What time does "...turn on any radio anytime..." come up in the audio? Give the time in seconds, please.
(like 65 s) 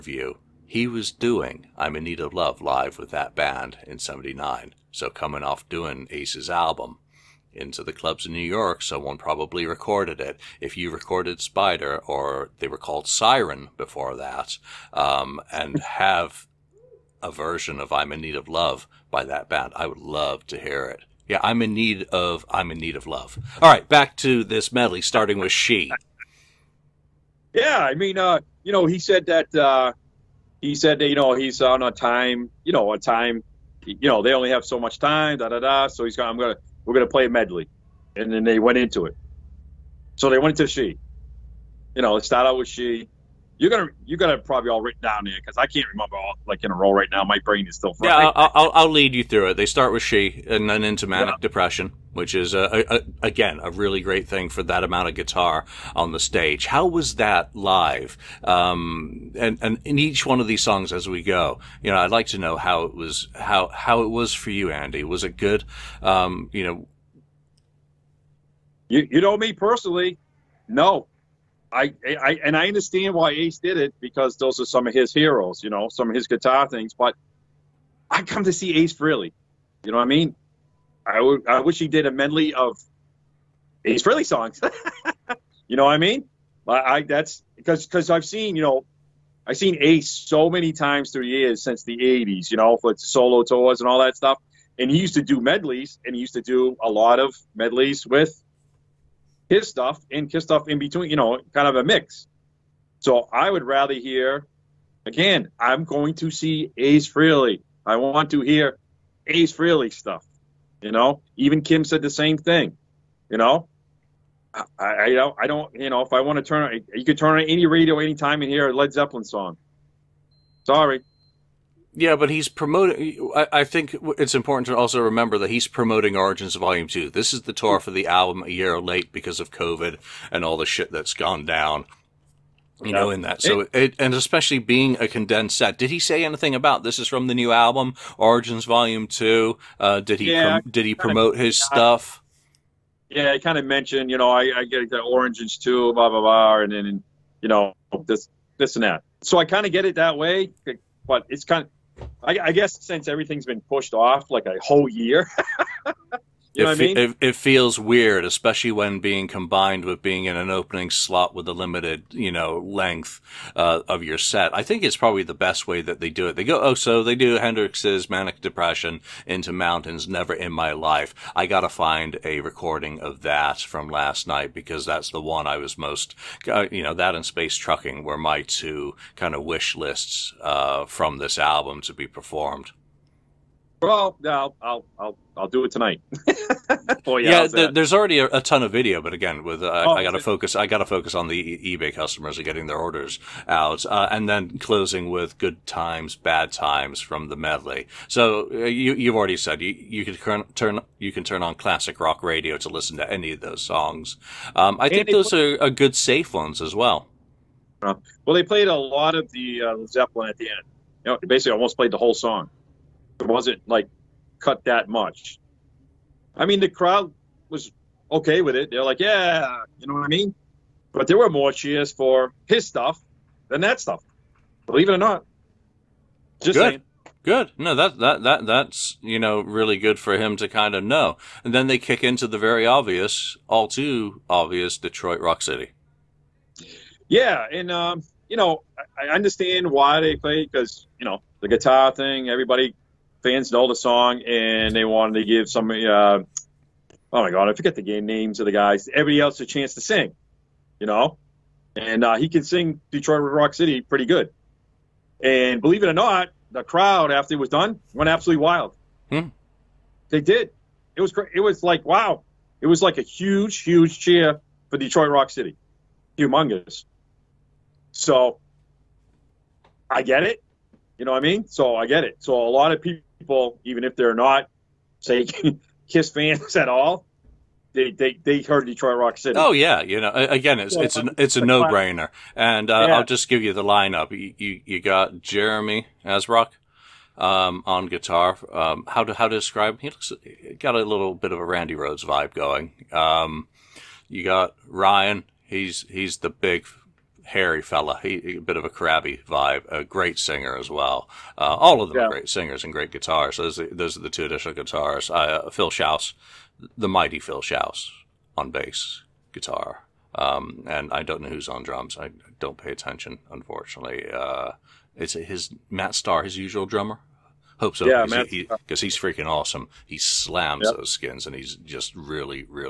117 s.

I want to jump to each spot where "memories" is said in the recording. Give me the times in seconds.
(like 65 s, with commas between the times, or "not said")
not said.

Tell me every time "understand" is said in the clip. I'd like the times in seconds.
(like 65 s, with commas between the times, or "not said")
72 s, 239 s.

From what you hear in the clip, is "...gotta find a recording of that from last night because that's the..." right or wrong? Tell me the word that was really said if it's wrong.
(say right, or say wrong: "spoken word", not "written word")
right.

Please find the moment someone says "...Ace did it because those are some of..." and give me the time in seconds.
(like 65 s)
73 s.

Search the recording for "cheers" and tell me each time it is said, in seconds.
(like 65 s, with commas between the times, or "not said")
221 s, 263 s.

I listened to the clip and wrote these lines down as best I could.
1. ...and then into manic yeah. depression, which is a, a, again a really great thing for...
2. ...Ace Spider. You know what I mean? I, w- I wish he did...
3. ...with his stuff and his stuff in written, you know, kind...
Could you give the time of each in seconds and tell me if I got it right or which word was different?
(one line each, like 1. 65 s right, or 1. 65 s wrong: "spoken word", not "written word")
1. 50 s right
2. 78 s wrong: "Frehley", not "Spider"
3. 98 s wrong: "between", not "written".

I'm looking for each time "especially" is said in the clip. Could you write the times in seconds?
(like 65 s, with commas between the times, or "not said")
134 s, 158 s.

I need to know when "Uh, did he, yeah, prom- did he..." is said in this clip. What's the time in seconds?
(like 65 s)
139 s.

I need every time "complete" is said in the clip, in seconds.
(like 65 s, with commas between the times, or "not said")
not said.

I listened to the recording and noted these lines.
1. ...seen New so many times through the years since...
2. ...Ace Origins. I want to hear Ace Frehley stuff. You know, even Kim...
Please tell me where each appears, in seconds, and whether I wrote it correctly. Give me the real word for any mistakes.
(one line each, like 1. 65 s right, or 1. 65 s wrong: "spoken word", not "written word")
1. 89 s wrong: "Ace", not "New"
2. 106 s wrong: "Frehley", not "Origins".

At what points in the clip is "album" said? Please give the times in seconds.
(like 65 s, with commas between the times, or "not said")
6 s, 128 s, 137 s, 181 s.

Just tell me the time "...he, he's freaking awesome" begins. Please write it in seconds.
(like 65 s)
318 s.